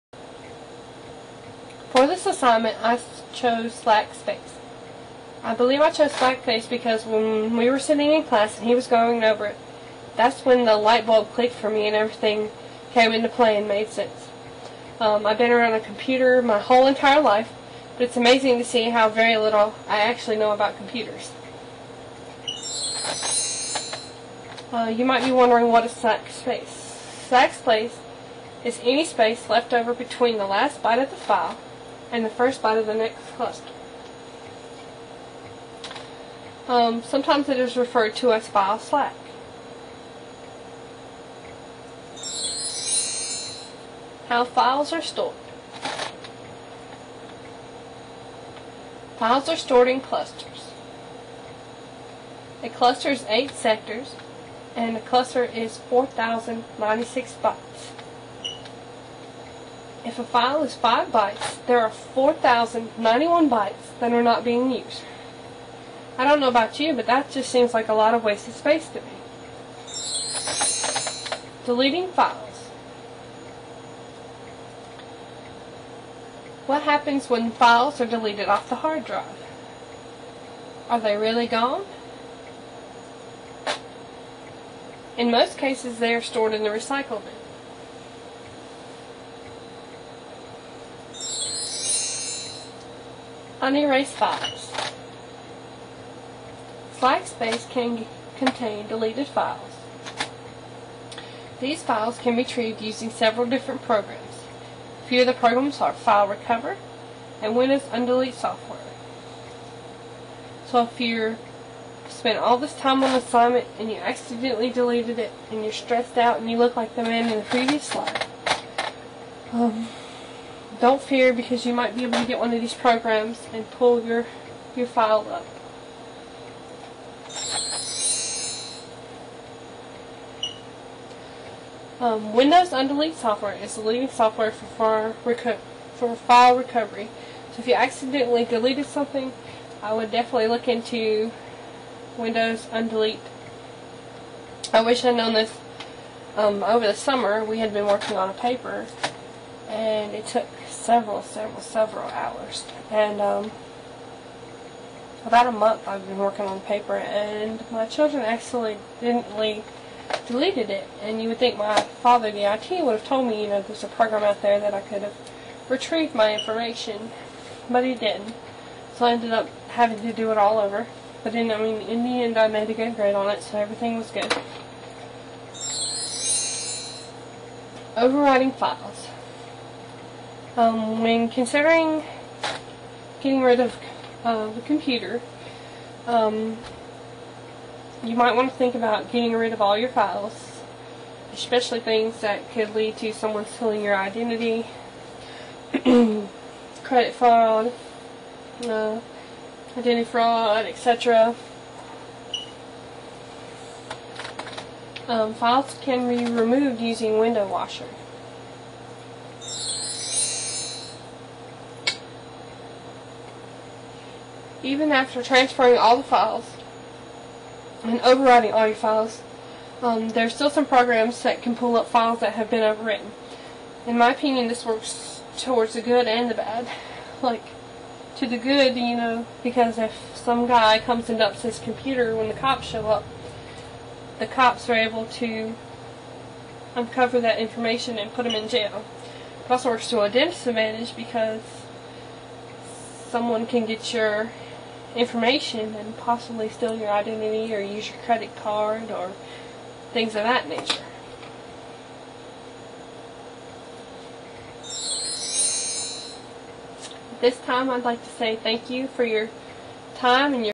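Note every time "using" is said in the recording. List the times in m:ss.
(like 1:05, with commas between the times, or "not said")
1:42, 3:26.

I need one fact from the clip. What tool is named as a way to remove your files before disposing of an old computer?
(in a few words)
Window Washer.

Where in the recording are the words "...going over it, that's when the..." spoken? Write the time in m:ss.
0:08.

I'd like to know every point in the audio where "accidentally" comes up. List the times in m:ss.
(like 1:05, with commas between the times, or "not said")
1:53, 2:17, 2:38.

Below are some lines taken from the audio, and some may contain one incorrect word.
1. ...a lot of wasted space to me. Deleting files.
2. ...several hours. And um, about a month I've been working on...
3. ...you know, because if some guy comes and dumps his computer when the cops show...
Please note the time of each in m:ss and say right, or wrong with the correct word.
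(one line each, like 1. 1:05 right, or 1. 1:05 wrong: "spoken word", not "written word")
1. 1:07 right
2. 2:31 right
3. 3:48 right.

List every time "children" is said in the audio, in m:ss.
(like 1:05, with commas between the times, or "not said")
2:37.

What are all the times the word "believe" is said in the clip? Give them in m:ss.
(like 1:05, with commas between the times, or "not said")
0:05.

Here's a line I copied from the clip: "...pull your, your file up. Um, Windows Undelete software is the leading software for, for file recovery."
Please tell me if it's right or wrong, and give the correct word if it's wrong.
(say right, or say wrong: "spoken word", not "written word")
right.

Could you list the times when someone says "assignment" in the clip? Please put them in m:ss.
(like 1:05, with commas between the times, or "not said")
0:02, 1:53.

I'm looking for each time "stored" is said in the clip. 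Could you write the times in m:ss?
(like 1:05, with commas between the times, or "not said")
0:45, 0:49, 1:26.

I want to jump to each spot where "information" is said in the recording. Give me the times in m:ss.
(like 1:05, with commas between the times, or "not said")
2:46, 3:57, 4:04.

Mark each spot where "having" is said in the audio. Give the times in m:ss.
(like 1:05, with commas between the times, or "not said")
2:49.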